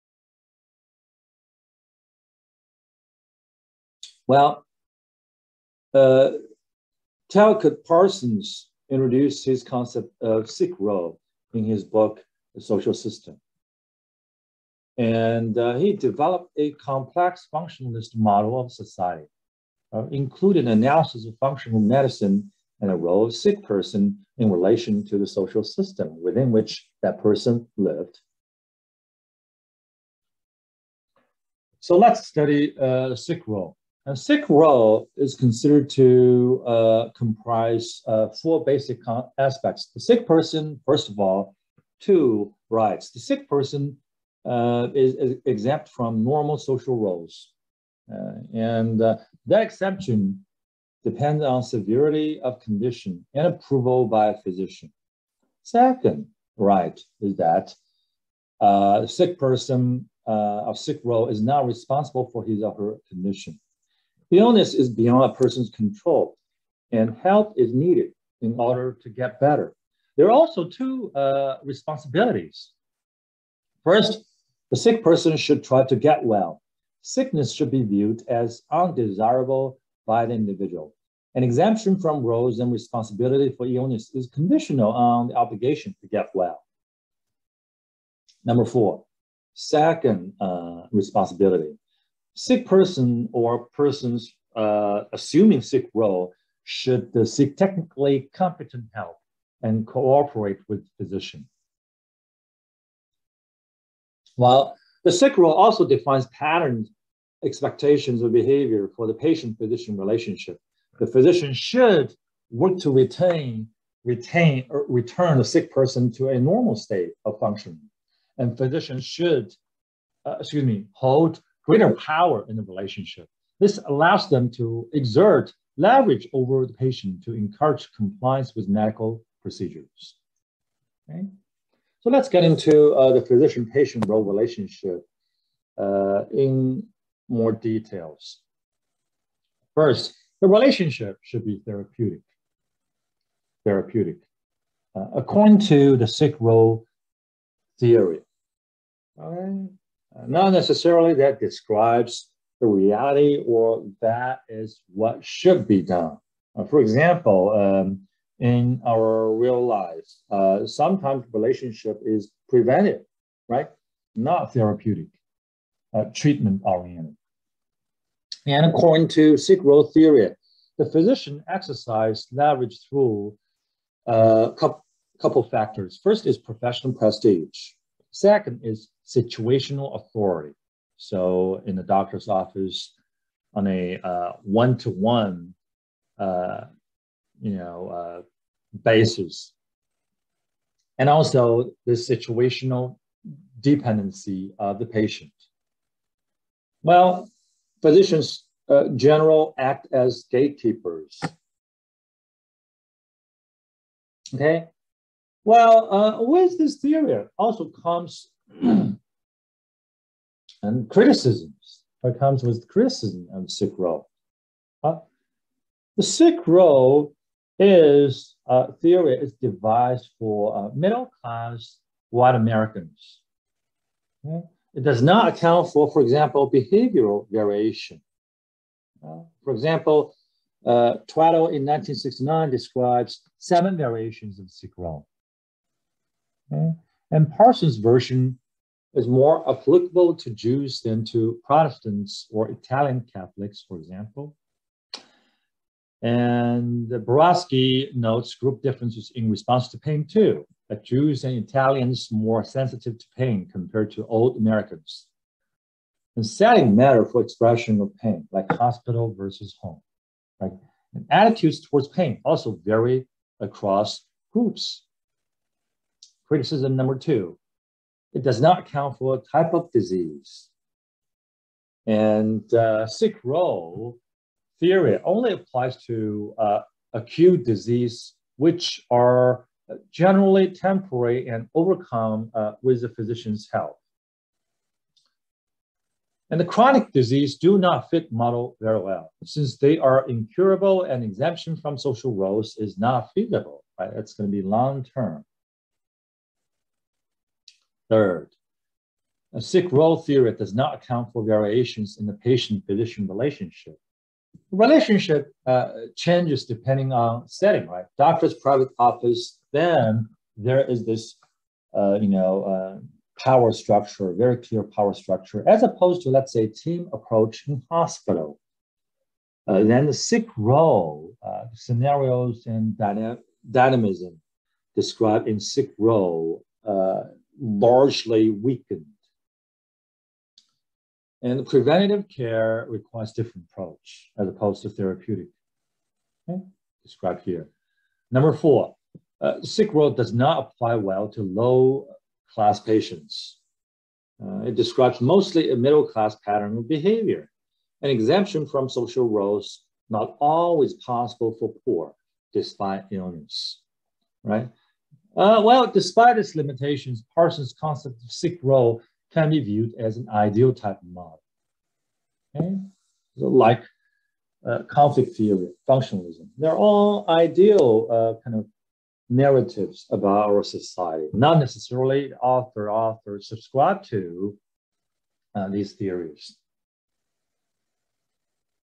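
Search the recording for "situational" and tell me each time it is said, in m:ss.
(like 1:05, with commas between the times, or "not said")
2:59, 3:11.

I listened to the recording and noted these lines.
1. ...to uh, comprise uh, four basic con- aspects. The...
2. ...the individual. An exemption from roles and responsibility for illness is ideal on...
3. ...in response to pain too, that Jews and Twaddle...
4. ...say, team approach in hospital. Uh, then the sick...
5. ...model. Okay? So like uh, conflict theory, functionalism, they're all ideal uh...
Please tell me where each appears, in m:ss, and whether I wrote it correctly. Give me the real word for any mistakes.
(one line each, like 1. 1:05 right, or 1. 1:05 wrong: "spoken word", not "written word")
1. 0:35 right
2. 1:20 wrong: "conditional", not "ideal"
3. 4:09 wrong: "Italians", not "Twaddle"
4. 5:16 right
5. 6:00 right.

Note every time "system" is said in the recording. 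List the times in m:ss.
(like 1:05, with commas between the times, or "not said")
0:12, 0:25.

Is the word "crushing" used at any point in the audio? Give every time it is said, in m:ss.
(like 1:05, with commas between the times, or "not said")
not said.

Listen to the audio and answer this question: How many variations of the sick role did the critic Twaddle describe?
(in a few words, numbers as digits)
7.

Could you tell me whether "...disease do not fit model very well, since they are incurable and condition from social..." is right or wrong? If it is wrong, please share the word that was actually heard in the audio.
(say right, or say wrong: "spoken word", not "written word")
wrong: "exemption", not "condition".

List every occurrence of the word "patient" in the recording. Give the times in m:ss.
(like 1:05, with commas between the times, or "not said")
1:49, 2:06, 2:13, 3:14, 5:02, 5:42.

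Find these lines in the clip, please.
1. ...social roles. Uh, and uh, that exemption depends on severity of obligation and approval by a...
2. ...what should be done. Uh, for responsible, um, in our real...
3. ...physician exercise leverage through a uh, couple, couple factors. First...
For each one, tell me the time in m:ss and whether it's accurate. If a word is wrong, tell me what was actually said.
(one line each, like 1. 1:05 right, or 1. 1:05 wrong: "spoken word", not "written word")
1. 0:46 wrong: "condition", not "obligation"
2. 2:34 wrong: "example", not "responsible"
3. 2:50 right.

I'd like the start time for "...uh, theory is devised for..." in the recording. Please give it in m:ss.
3:38.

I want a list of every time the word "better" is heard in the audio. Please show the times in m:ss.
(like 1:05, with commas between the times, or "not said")
1:09.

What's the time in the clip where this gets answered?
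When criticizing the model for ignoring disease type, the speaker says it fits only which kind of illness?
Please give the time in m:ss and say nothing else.
4:36.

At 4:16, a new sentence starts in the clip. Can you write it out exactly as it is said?
And setting matter for expression of pain, like hospital versus home.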